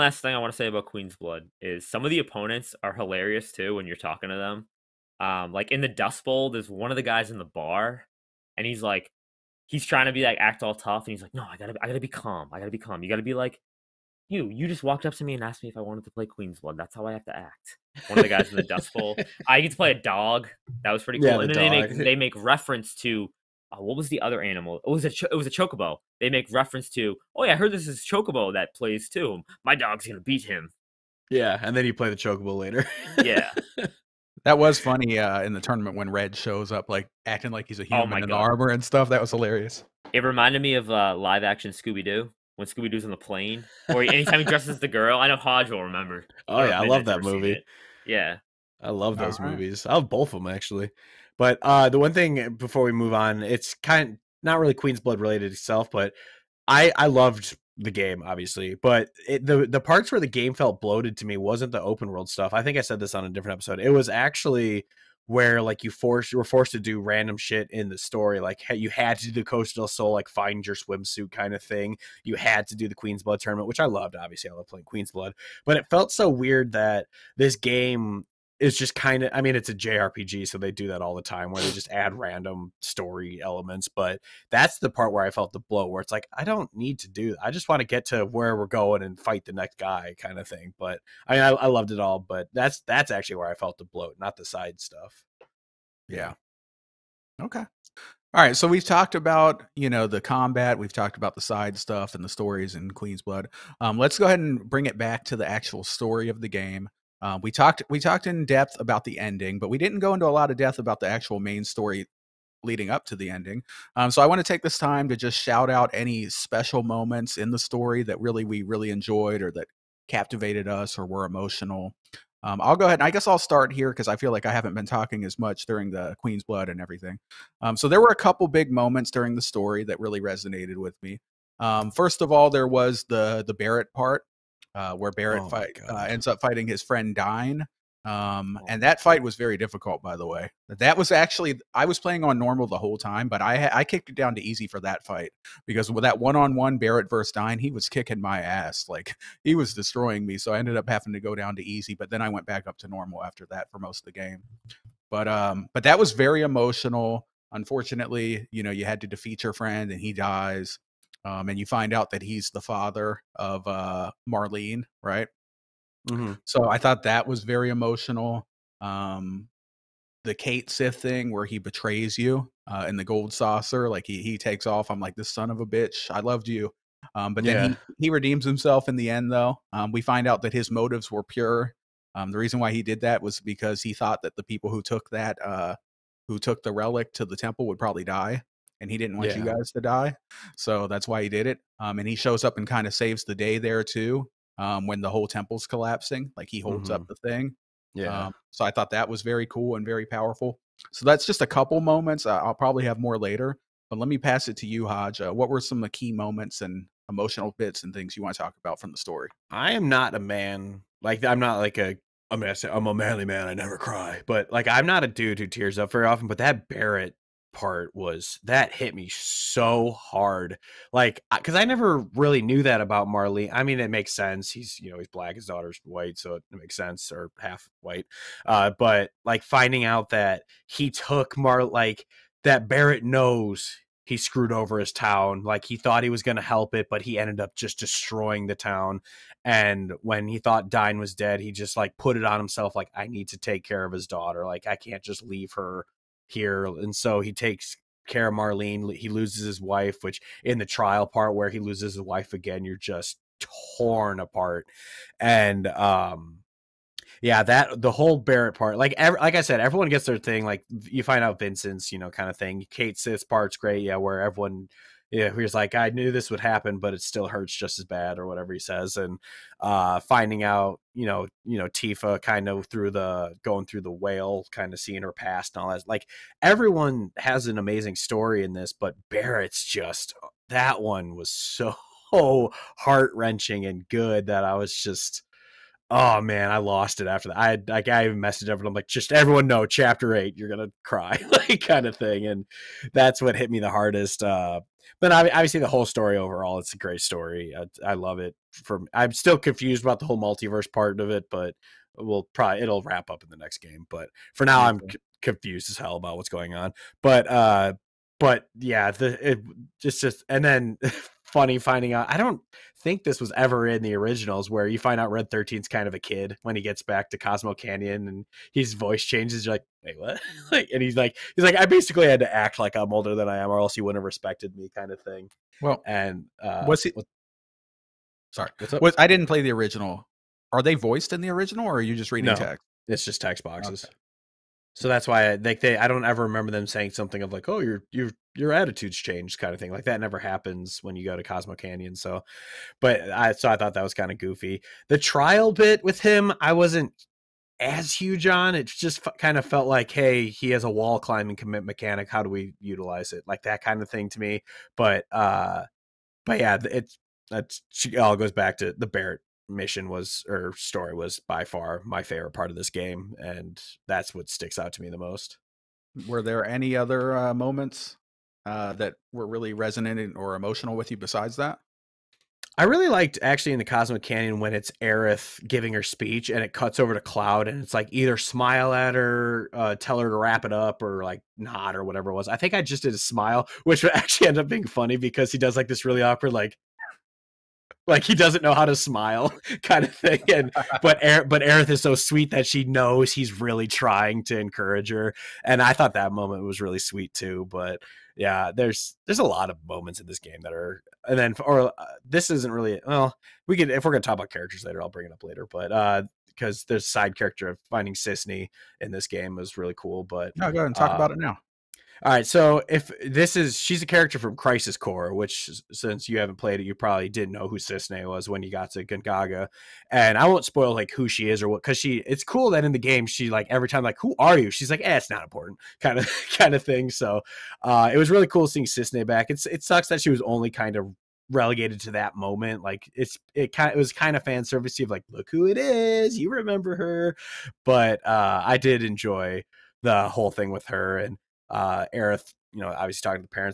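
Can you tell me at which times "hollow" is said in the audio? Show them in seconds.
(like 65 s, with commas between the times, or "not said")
not said.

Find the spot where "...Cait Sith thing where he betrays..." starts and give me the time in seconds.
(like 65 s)
170 s.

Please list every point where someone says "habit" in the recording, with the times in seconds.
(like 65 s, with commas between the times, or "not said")
not said.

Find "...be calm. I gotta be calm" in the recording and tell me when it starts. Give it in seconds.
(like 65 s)
11 s.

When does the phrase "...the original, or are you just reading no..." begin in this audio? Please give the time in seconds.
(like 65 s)
331 s.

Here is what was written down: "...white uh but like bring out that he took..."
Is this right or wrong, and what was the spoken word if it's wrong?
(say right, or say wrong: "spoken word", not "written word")
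wrong: "finding", not "bring".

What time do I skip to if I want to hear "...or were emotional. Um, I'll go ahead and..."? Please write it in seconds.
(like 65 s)
120 s.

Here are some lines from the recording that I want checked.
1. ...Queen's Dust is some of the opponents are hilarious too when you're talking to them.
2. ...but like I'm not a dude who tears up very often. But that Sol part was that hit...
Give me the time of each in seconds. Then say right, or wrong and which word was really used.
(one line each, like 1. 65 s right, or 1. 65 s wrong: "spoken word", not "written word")
1. 0 s wrong: "Blood", not "Dust"
2. 214 s wrong: "Barrett", not "Sol".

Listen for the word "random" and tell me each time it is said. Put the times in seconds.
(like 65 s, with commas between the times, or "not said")
66 s, 82 s.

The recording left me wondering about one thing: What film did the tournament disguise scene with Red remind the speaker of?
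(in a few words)
Live action Scooby Doo.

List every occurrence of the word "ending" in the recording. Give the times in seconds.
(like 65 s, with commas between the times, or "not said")
109 s, 113 s.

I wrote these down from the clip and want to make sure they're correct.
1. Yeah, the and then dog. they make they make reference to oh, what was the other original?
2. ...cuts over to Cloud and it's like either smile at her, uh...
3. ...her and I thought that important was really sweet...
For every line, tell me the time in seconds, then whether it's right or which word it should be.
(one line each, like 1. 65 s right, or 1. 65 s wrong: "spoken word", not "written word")
1. 21 s wrong: "animal", not "original"
2. 376 s right
3. 394 s wrong: "moment", not "important".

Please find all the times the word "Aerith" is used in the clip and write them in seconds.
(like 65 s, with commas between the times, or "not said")
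374 s, 391 s, 441 s.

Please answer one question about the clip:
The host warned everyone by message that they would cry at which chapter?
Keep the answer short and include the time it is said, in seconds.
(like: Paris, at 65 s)
Chapter eight, at 289 s.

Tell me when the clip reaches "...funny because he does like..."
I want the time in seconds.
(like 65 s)
384 s.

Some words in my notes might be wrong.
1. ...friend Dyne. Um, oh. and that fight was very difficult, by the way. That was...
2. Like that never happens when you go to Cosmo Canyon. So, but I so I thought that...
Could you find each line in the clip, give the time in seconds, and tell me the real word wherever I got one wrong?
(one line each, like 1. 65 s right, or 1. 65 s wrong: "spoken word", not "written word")
1. 136 s right
2. 339 s right.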